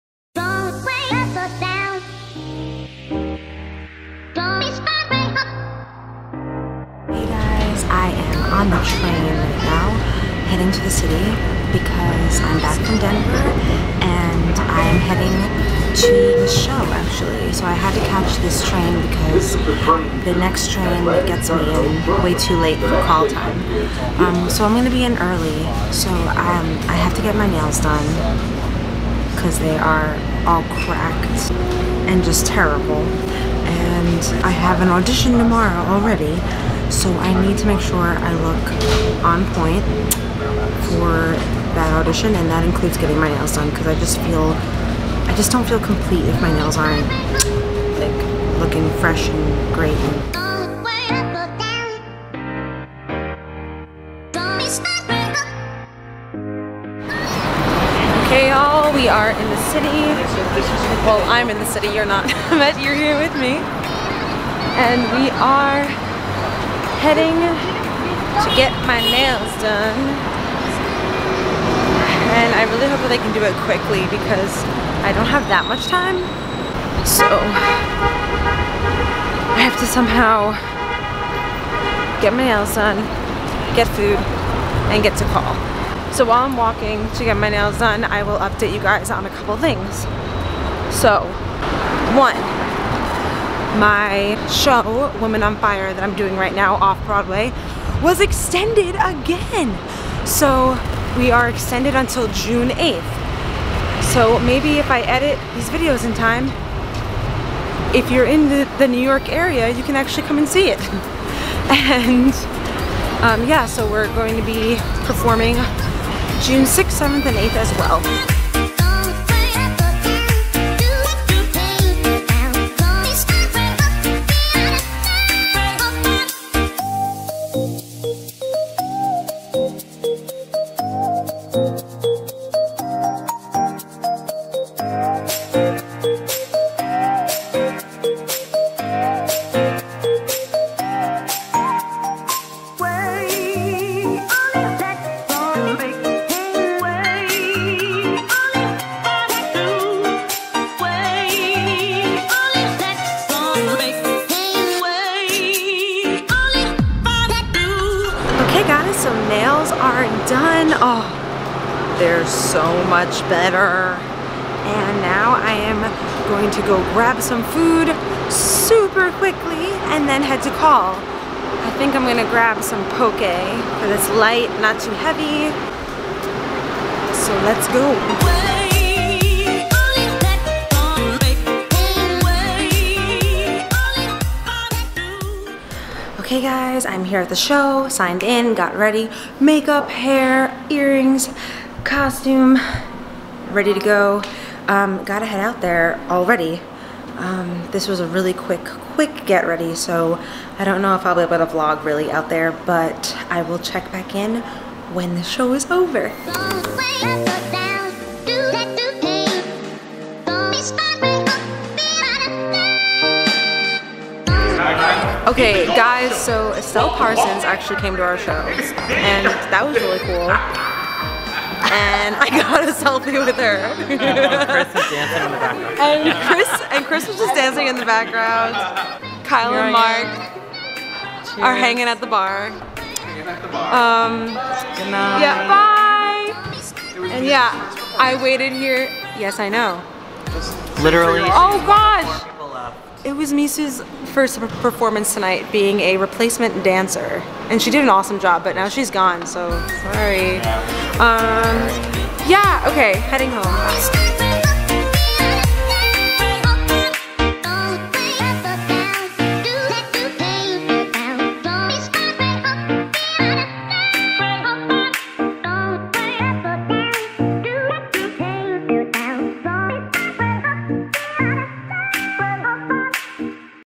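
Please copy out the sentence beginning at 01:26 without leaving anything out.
So while I'm walking to get my nails done, I will update you guys on a couple things.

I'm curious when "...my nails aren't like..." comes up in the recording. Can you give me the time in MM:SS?
00:46.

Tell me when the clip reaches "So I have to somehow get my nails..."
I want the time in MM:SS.
01:17.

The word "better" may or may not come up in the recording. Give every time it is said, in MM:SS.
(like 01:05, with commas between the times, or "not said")
02:43.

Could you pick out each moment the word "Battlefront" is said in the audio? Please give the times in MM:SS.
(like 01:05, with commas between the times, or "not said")
not said.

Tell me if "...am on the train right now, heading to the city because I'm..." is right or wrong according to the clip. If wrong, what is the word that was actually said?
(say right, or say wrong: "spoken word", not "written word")
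right.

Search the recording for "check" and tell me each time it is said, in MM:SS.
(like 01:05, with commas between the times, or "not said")
03:23.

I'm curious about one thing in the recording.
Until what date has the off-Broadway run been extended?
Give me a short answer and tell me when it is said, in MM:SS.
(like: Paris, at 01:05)
June 8th, at 01:42.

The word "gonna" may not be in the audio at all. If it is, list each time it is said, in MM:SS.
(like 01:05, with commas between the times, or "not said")
00:24, 02:52.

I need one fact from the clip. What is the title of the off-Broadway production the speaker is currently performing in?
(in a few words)
Women on Fire.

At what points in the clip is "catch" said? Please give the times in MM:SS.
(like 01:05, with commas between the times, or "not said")
00:18.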